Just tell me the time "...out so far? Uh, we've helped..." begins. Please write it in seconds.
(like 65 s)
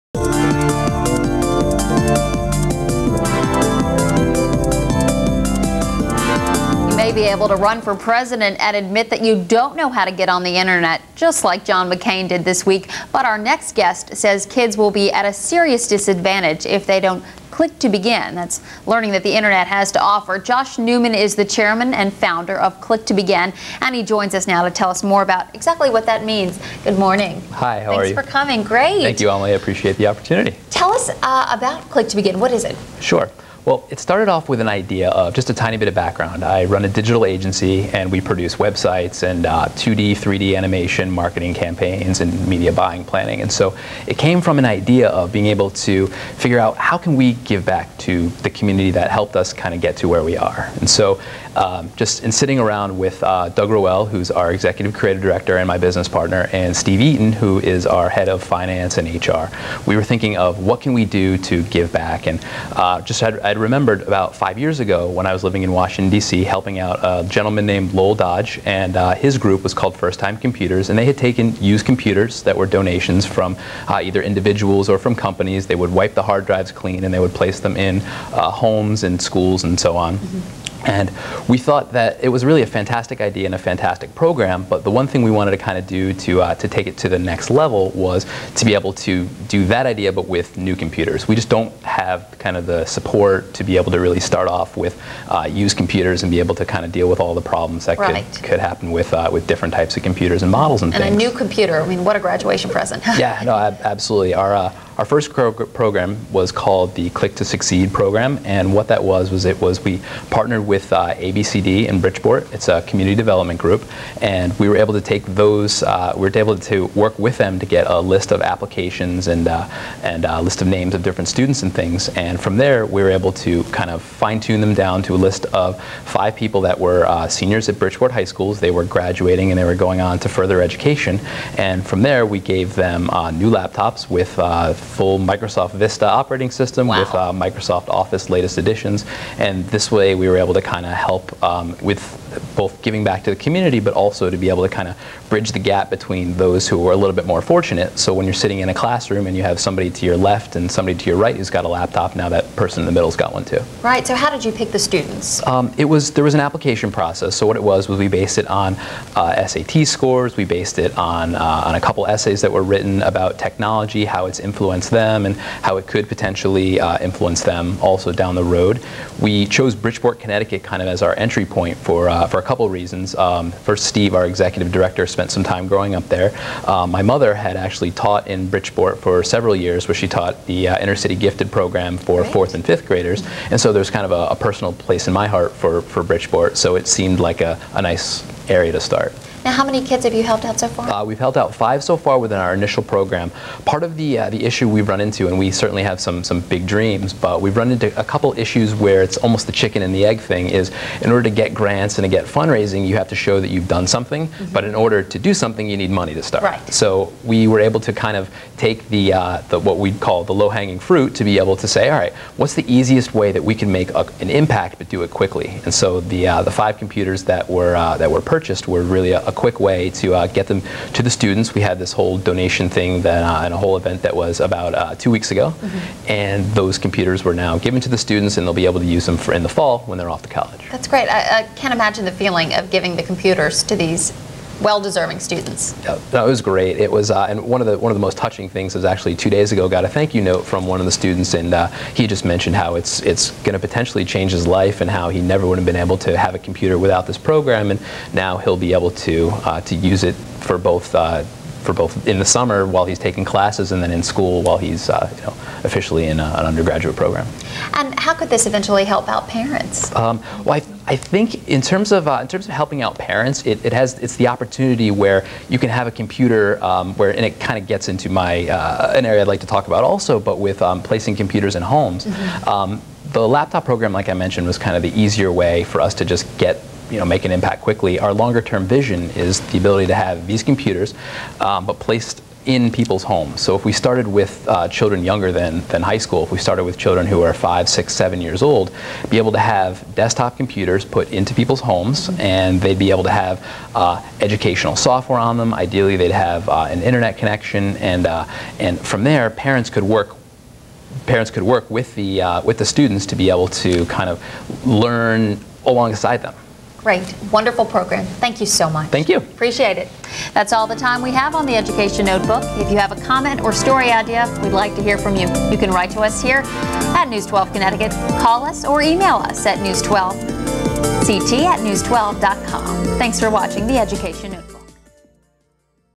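190 s.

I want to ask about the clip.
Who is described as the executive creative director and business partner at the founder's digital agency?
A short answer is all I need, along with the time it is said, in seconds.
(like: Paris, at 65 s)
Doug Rowell, at 53 s.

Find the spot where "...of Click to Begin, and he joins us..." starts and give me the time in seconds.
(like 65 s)
22 s.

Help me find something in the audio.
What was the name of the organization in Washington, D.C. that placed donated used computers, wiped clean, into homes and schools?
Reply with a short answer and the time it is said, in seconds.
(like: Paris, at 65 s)
First Time Computers, at 69 s.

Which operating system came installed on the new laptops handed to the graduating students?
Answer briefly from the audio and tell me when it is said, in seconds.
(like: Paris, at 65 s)
Microsoft Vista, at 135 s.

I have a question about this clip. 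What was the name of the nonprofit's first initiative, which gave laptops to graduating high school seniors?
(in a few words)
Click to Succeed.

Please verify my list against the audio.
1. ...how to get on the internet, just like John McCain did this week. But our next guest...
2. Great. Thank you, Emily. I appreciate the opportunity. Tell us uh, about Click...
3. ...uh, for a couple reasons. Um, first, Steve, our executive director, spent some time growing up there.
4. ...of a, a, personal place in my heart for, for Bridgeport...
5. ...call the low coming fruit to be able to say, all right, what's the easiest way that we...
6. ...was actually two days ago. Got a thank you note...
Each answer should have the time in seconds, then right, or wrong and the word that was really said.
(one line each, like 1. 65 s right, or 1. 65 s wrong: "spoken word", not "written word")
1. 9 s right
2. 28 s right
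3. 172 s right
4. 184 s right
5. 209 s wrong: "hanging", not "coming"
6. 238 s right.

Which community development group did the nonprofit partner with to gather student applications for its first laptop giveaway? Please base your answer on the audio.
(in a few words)
ABCD.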